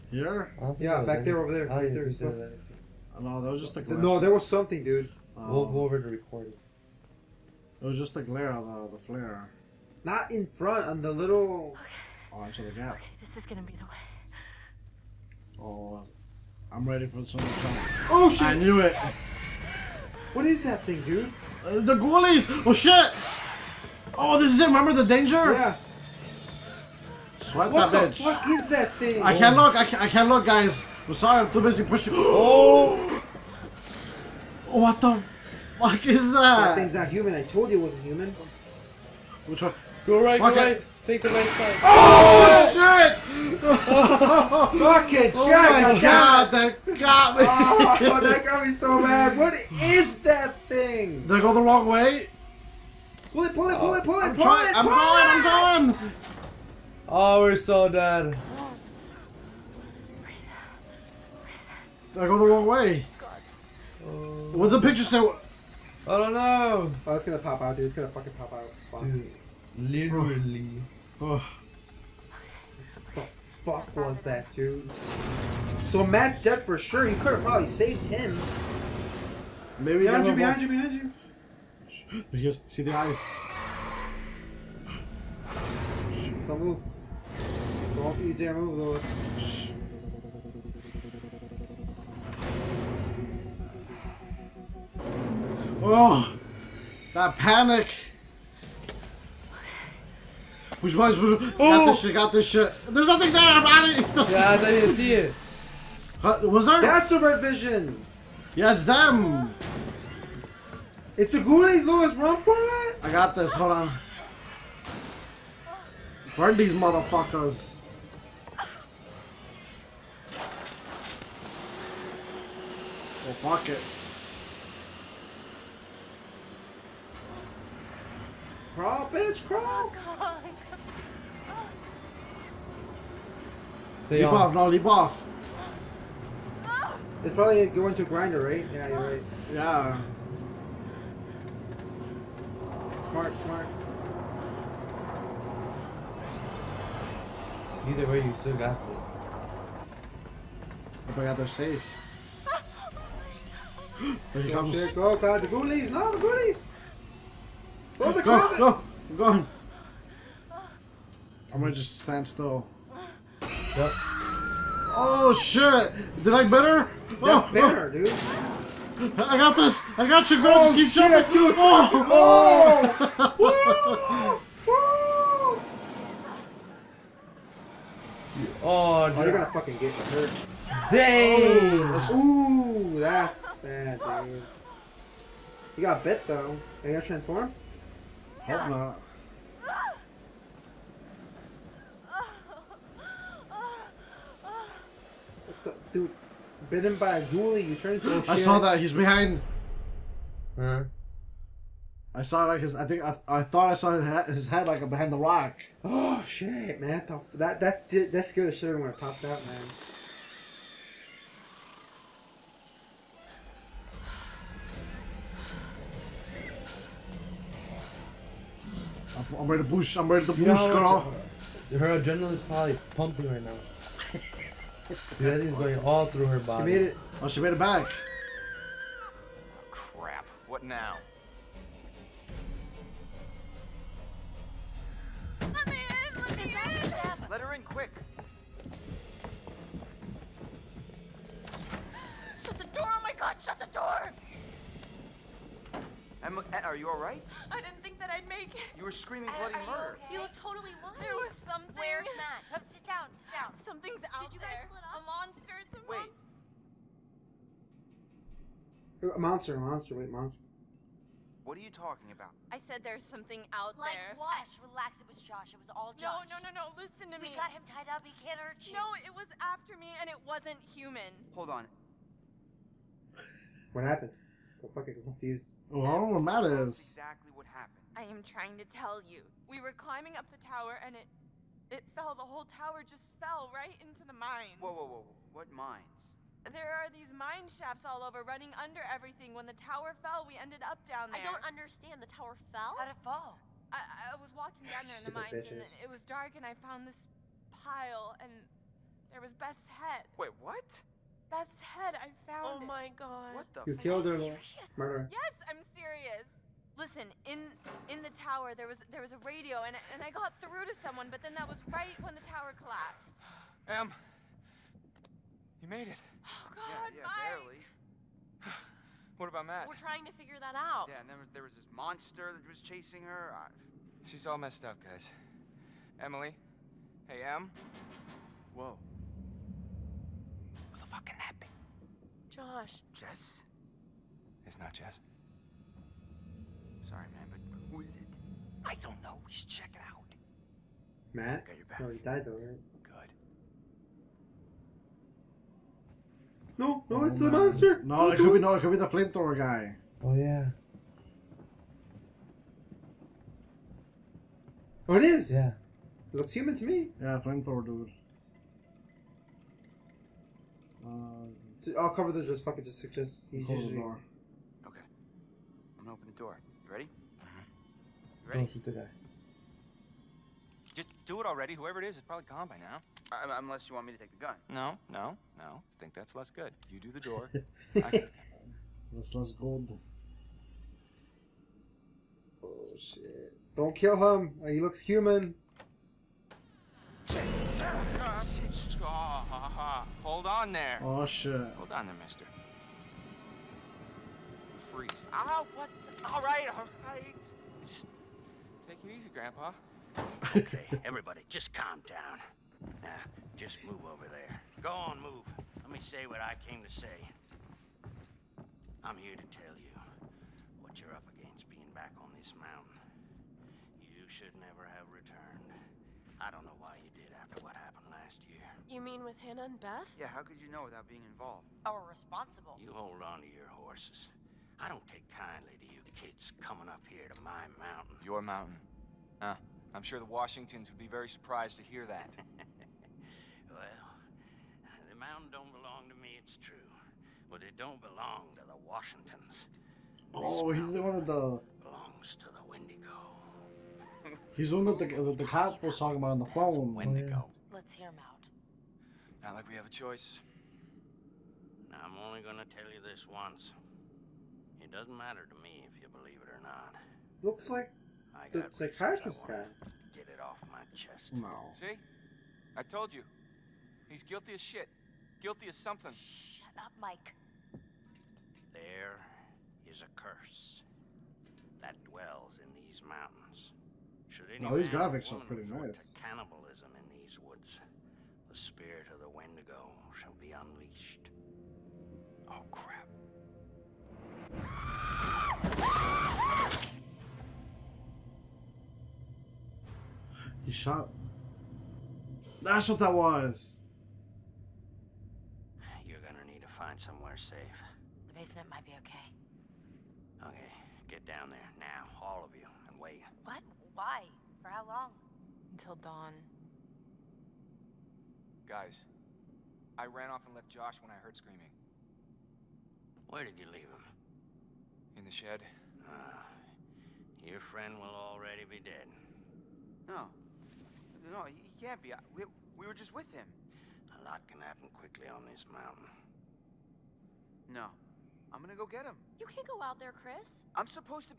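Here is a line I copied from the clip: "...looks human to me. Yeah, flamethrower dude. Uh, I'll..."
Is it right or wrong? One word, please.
right.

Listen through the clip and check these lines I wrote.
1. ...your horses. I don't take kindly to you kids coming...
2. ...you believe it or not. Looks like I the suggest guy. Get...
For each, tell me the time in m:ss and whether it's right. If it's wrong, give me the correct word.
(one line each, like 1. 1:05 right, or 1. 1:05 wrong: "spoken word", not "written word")
1. 7:03 right
2. 7:35 wrong: "psychiatrist", not "suggest".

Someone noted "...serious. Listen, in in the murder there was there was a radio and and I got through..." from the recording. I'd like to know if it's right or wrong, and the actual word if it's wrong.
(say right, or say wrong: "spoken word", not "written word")
wrong: "tower", not "murder".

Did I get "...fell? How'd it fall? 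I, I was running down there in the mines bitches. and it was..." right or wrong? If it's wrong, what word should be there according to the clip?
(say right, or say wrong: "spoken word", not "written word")
wrong: "walking", not "running".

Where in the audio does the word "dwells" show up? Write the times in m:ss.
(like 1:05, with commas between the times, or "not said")
7:51.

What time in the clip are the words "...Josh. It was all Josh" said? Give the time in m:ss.
4:25.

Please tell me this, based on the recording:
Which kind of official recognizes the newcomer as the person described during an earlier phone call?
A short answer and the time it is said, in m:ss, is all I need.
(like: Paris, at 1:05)
The cop, at 7:25.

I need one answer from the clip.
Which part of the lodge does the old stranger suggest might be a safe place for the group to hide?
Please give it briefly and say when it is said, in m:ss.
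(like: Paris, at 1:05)
The basement, at 8:18.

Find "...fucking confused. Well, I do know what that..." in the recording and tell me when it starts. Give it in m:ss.
4:34.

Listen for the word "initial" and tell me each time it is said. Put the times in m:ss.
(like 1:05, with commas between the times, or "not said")
not said.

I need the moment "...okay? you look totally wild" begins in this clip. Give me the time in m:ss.
4:09.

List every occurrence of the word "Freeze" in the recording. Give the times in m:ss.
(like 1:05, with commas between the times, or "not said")
6:34.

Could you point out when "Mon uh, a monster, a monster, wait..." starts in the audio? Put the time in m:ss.
4:19.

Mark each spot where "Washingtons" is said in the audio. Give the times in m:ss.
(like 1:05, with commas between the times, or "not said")
7:10, 7:18.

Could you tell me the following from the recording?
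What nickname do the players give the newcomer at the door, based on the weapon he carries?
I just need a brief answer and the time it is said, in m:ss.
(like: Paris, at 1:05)
Flamethrower guy, at 5:48.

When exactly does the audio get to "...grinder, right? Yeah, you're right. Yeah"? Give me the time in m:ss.
2:18.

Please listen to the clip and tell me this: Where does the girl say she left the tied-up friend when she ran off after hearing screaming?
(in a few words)
In the shed.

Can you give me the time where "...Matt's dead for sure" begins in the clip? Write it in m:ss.
1:16.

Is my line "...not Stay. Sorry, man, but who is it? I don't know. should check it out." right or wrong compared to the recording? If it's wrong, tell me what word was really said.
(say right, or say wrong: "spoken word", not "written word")
wrong: "Jess", not "Stay".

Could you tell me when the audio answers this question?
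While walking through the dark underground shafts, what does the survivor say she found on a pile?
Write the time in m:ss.
4:59.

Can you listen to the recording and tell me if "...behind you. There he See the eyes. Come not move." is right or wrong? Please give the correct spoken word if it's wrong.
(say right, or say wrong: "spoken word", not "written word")
right.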